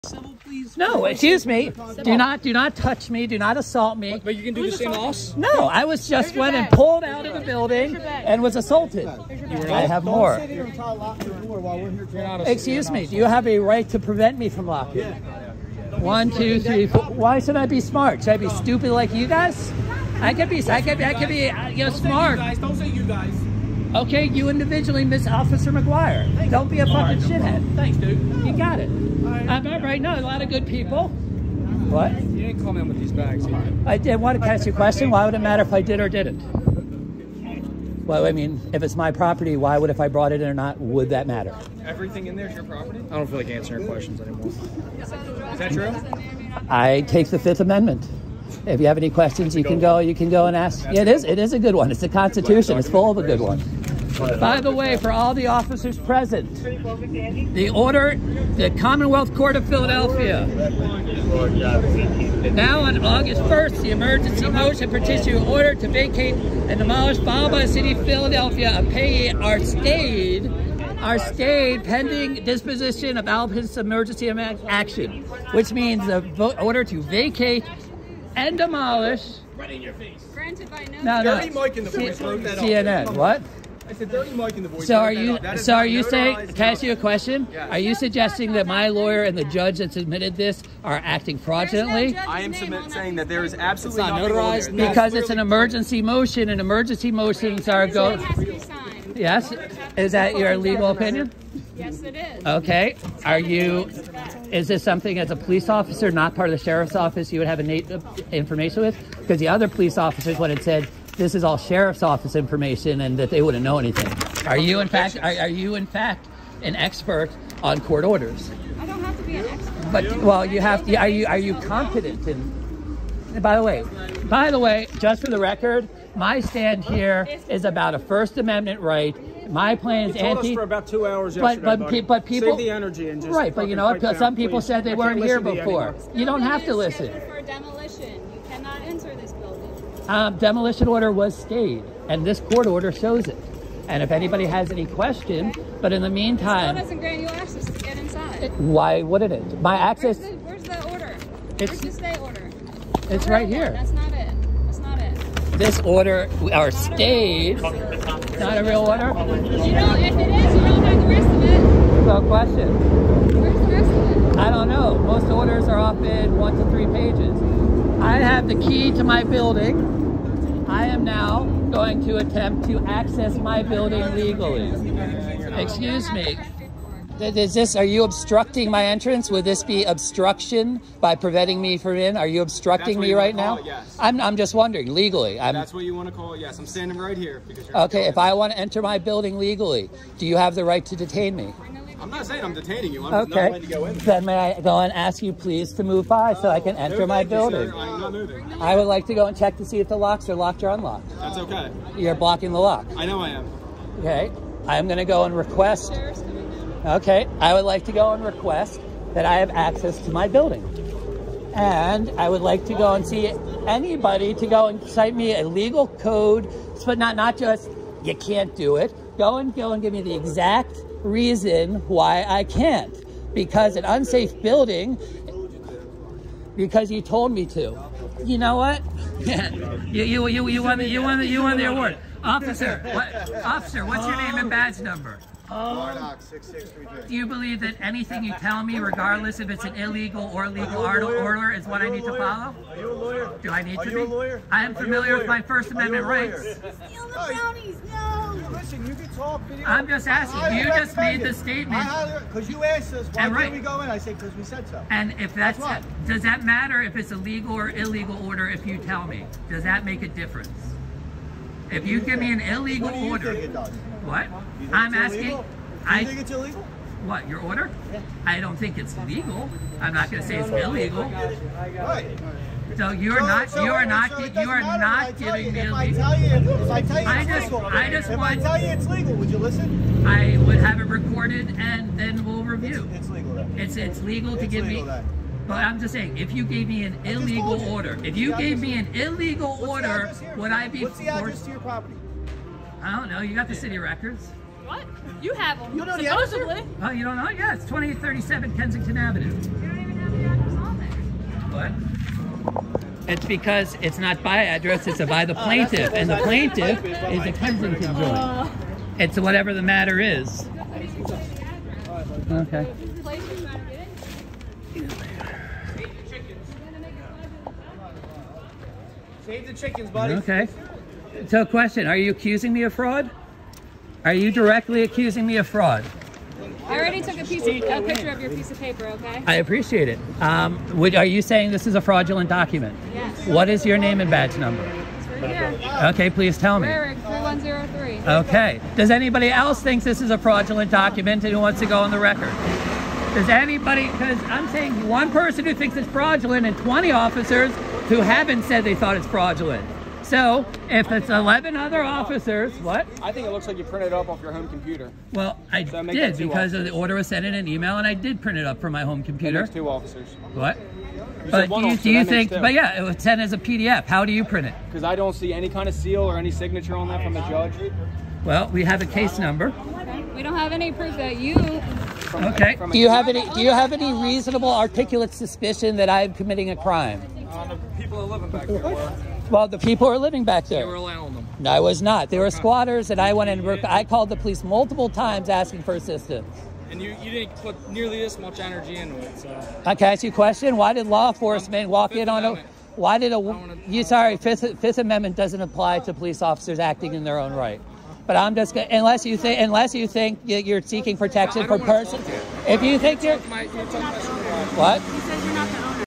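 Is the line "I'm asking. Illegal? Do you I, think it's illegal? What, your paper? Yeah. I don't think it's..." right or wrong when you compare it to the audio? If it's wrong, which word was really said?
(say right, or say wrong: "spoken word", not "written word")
wrong: "order", not "paper".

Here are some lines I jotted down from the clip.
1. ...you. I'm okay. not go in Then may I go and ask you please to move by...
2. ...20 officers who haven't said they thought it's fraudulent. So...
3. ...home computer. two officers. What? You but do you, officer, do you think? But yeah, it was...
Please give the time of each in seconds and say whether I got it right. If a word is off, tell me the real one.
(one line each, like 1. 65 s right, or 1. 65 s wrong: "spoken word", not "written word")
1. 192 s right
2. 346 s right
3. 358 s right.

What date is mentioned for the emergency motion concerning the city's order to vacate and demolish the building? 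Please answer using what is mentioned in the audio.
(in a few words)
August 1st.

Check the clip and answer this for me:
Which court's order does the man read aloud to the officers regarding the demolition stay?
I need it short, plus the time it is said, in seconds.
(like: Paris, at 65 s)
Commonwealth Court, at 58 s.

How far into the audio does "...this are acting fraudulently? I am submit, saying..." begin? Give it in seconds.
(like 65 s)
90 s.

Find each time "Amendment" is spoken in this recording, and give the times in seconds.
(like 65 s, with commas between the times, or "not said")
47 s, 128 s, 245 s, 394 s.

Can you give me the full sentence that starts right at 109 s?
Because the other police officers would have said, this is all sheriff's office information and that they wouldn't know anything.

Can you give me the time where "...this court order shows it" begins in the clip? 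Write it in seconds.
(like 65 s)
142 s.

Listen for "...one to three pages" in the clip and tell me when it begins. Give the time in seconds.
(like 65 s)
166 s.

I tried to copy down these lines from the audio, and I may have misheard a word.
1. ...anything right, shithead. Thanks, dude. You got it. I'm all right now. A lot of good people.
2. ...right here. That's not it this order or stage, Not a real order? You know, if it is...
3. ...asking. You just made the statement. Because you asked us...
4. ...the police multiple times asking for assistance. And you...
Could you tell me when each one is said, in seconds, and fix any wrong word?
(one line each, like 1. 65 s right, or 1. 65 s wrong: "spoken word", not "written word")
1. 26 s wrong: "fucking", not "anything"
2. 153 s right
3. 250 s right
4. 384 s right.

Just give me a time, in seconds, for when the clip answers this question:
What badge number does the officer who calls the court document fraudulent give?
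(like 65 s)
336 s.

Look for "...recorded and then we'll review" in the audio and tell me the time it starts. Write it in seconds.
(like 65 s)
280 s.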